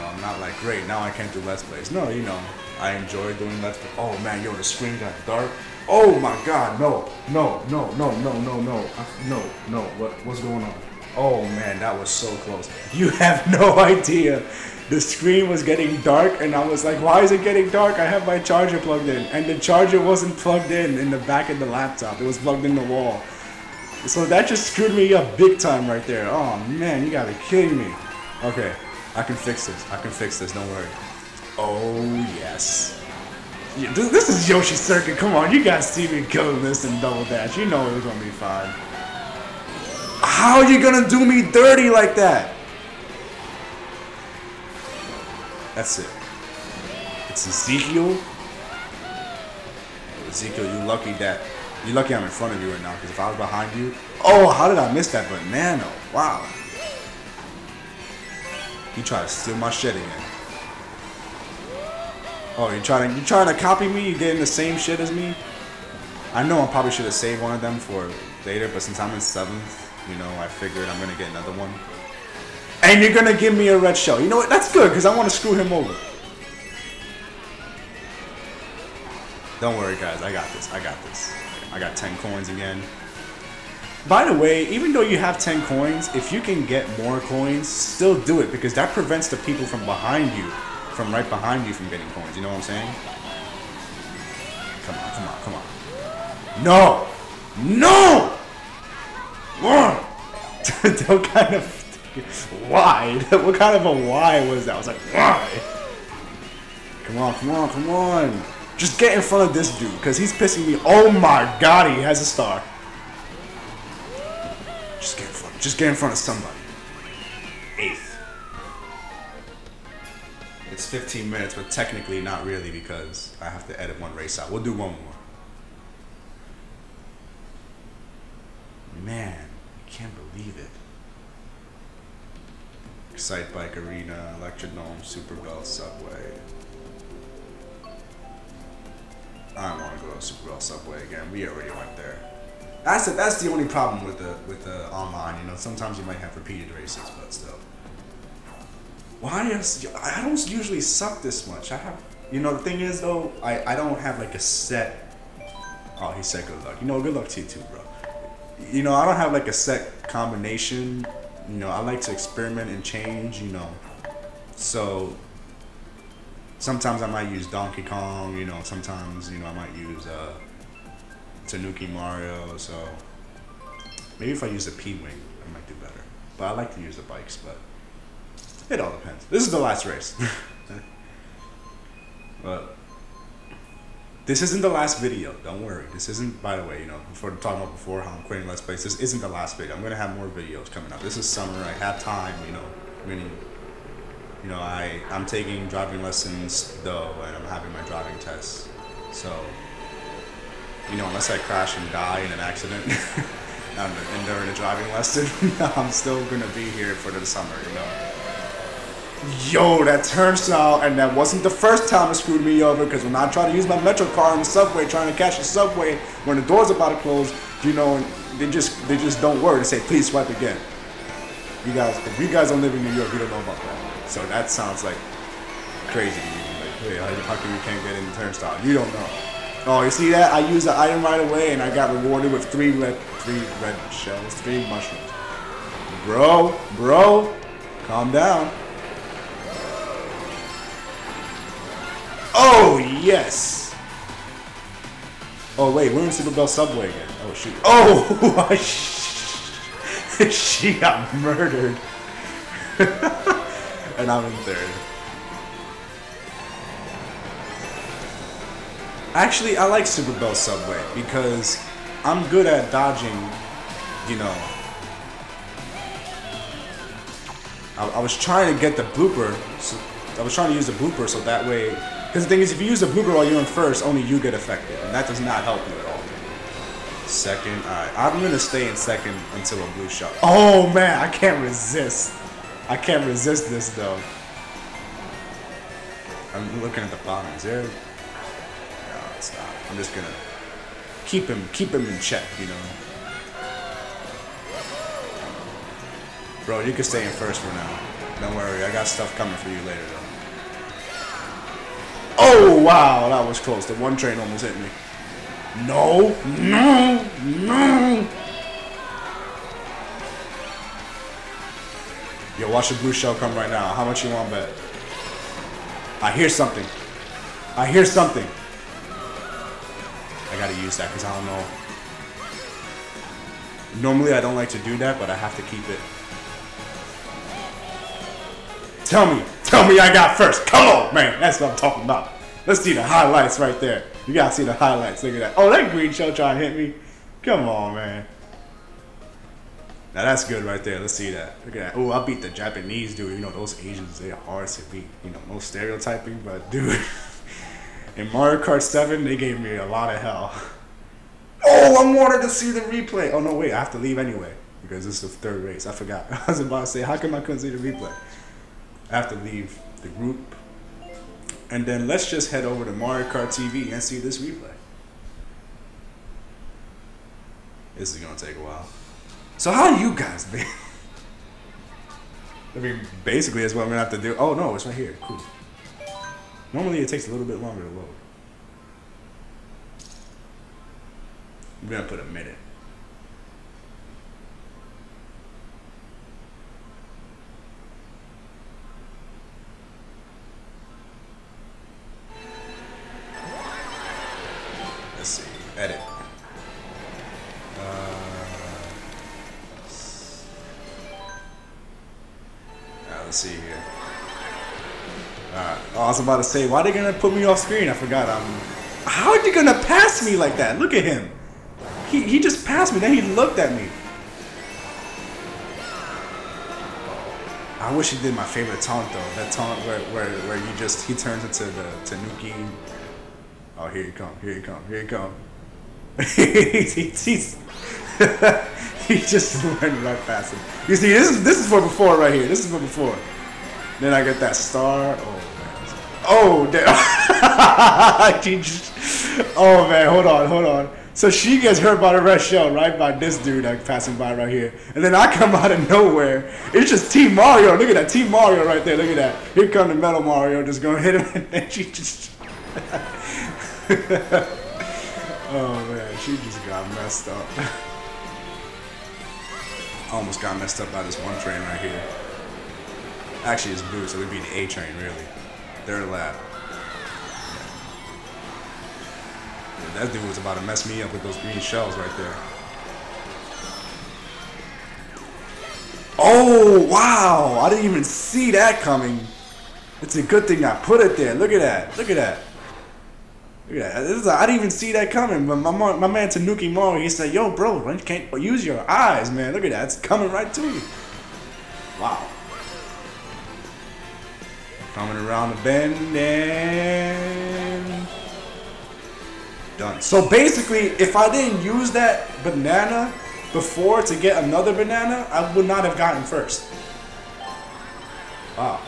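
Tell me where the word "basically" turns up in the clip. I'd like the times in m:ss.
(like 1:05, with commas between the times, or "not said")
6:13, 8:20.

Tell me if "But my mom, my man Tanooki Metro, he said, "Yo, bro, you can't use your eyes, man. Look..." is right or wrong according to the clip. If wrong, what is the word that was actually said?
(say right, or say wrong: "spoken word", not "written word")
wrong: "Mario", not "Metro".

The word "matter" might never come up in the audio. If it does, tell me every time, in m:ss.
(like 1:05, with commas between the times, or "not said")
not said.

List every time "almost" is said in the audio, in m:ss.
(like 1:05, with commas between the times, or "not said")
5:04, 7:39.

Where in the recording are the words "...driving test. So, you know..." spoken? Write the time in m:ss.
3:17.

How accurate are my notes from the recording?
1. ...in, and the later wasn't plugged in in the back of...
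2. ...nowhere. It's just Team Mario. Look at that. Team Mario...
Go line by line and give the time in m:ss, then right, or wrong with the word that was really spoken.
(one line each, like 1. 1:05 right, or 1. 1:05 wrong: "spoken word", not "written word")
1. 0:19 wrong: "charger", not "later"
2. 7:25 right.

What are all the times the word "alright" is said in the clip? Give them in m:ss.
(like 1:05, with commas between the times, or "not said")
4:37, 6:45.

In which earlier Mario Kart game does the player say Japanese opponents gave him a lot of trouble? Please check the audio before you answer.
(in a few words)
Mario Kart 7.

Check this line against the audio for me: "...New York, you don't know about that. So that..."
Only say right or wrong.
right.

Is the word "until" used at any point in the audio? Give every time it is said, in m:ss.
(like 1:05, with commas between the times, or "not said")
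4:39.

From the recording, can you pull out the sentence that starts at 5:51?
Oh, I wanted to see the replay.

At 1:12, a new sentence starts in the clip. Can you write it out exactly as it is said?
And you're gonna give me a red shell.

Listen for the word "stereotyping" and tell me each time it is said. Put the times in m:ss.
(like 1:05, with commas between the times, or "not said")
5:45.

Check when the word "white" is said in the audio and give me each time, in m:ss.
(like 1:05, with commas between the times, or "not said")
not said.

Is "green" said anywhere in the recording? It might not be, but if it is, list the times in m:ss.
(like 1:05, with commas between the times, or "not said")
5:35, 7:51.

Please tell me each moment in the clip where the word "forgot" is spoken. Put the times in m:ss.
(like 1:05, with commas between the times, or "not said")
5:55, 6:47.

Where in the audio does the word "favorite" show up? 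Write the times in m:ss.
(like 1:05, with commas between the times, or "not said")
6:58.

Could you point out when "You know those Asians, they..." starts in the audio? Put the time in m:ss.
5:43.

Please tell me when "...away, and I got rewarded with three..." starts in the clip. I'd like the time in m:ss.
3:51.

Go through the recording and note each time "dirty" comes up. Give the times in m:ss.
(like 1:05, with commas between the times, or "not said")
0:41.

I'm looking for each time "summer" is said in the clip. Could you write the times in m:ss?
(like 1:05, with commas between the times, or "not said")
3:11, 3:27.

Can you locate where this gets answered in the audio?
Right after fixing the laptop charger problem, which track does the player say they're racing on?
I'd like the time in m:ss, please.
0:34.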